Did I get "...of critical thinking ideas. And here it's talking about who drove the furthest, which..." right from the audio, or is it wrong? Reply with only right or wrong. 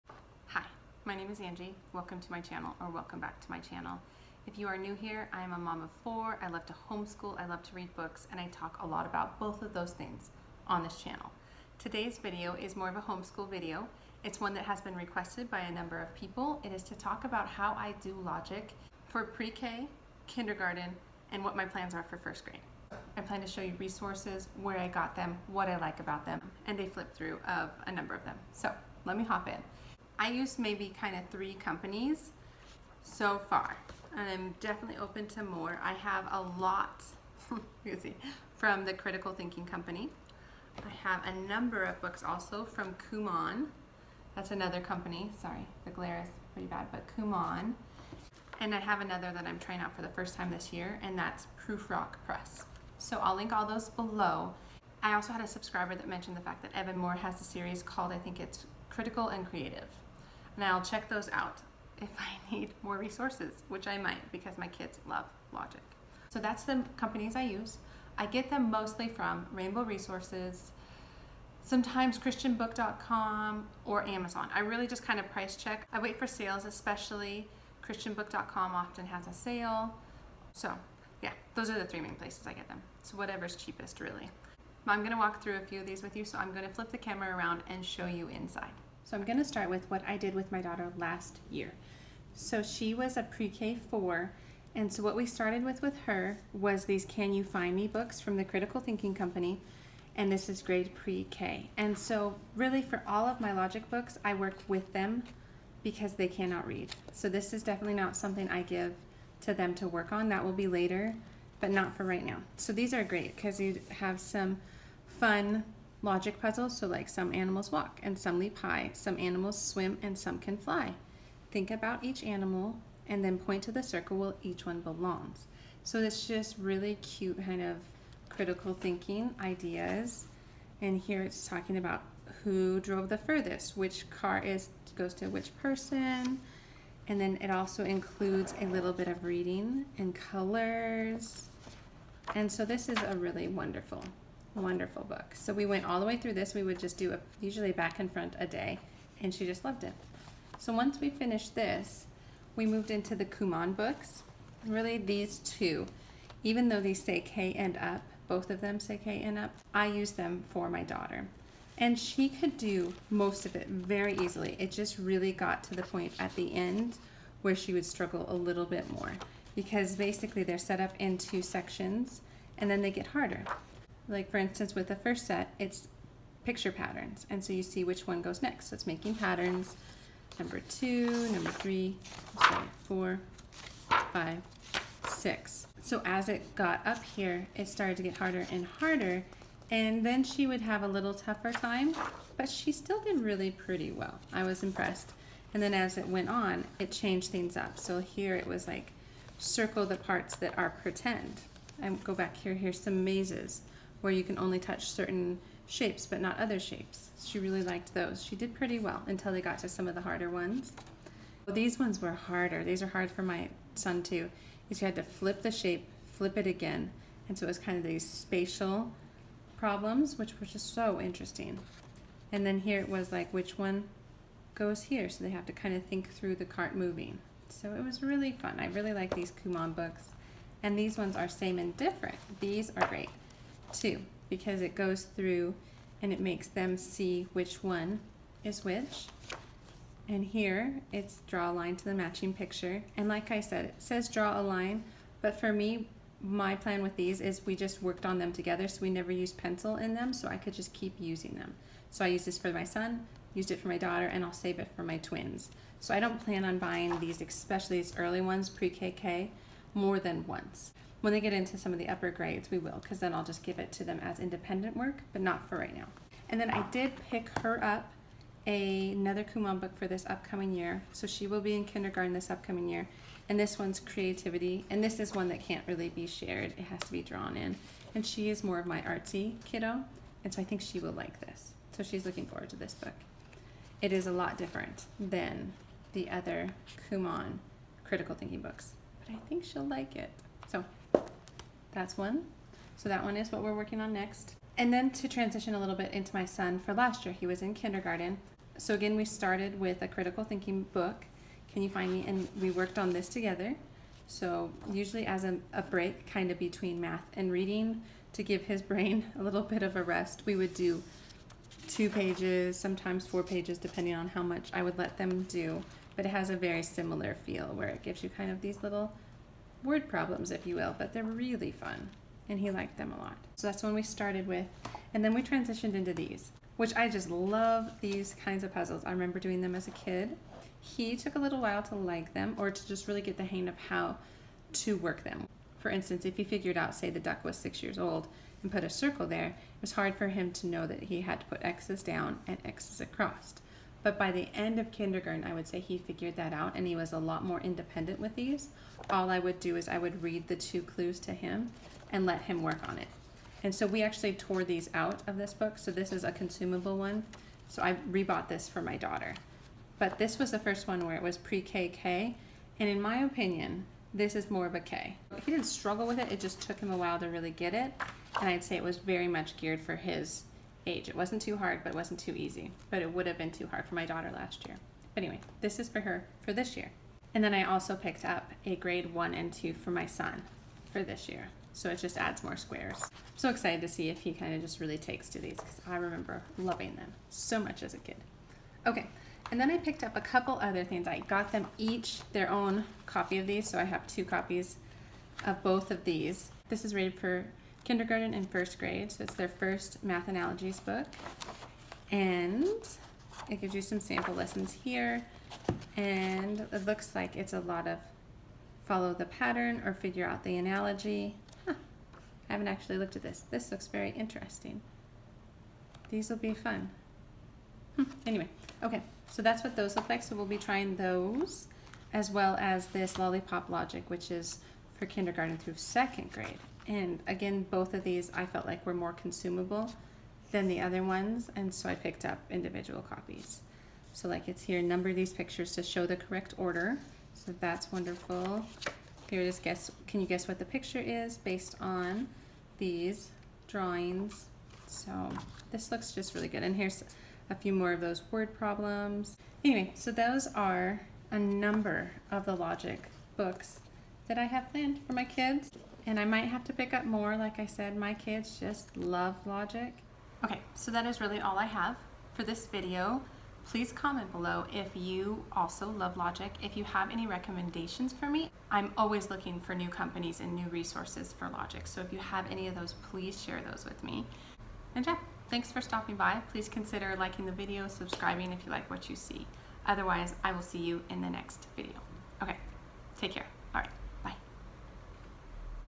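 right.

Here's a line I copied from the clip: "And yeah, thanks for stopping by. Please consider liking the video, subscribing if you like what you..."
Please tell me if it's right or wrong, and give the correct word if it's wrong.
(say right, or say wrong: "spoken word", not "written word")
right.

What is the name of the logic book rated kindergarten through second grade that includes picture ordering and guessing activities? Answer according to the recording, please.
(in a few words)
Lollipop Logic.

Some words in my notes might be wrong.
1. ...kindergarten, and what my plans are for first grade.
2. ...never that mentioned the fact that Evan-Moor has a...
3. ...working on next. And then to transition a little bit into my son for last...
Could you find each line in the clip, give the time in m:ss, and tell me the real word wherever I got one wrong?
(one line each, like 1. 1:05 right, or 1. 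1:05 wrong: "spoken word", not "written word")
1. 0:20 right
2. 0:55 wrong: "subscriber", not "never"
3. 4:53 right.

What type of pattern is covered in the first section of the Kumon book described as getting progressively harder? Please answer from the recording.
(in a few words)
Picture patterns.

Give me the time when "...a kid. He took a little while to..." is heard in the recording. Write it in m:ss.
5:29.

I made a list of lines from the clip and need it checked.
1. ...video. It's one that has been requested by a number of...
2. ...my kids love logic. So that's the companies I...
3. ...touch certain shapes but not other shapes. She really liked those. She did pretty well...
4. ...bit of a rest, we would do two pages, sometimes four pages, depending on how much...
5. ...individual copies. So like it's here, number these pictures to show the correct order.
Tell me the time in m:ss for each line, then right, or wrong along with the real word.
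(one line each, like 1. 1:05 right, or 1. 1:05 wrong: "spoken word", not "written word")
1. 0:13 right
2. 1:04 right
3. 3:24 right
4. 5:09 right
5. 7:12 right.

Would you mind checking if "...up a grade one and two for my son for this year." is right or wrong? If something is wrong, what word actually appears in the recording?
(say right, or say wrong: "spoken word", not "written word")
right.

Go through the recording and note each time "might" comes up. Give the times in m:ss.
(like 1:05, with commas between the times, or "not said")
1:03, 7:36.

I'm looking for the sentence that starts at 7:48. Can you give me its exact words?
I'm always looking for new companies and new resources for logic.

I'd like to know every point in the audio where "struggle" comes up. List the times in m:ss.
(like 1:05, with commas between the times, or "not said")
2:47, 6:05.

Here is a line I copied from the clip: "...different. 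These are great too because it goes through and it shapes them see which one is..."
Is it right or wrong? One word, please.
wrong.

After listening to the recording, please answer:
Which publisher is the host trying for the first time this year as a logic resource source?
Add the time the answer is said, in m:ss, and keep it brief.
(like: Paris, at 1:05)
Prufrock Press, at 0:51.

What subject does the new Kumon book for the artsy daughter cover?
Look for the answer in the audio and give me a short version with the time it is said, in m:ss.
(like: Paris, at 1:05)
Creativity, at 4:33.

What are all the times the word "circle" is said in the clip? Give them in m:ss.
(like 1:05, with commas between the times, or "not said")
2:03, 3:19, 5:38.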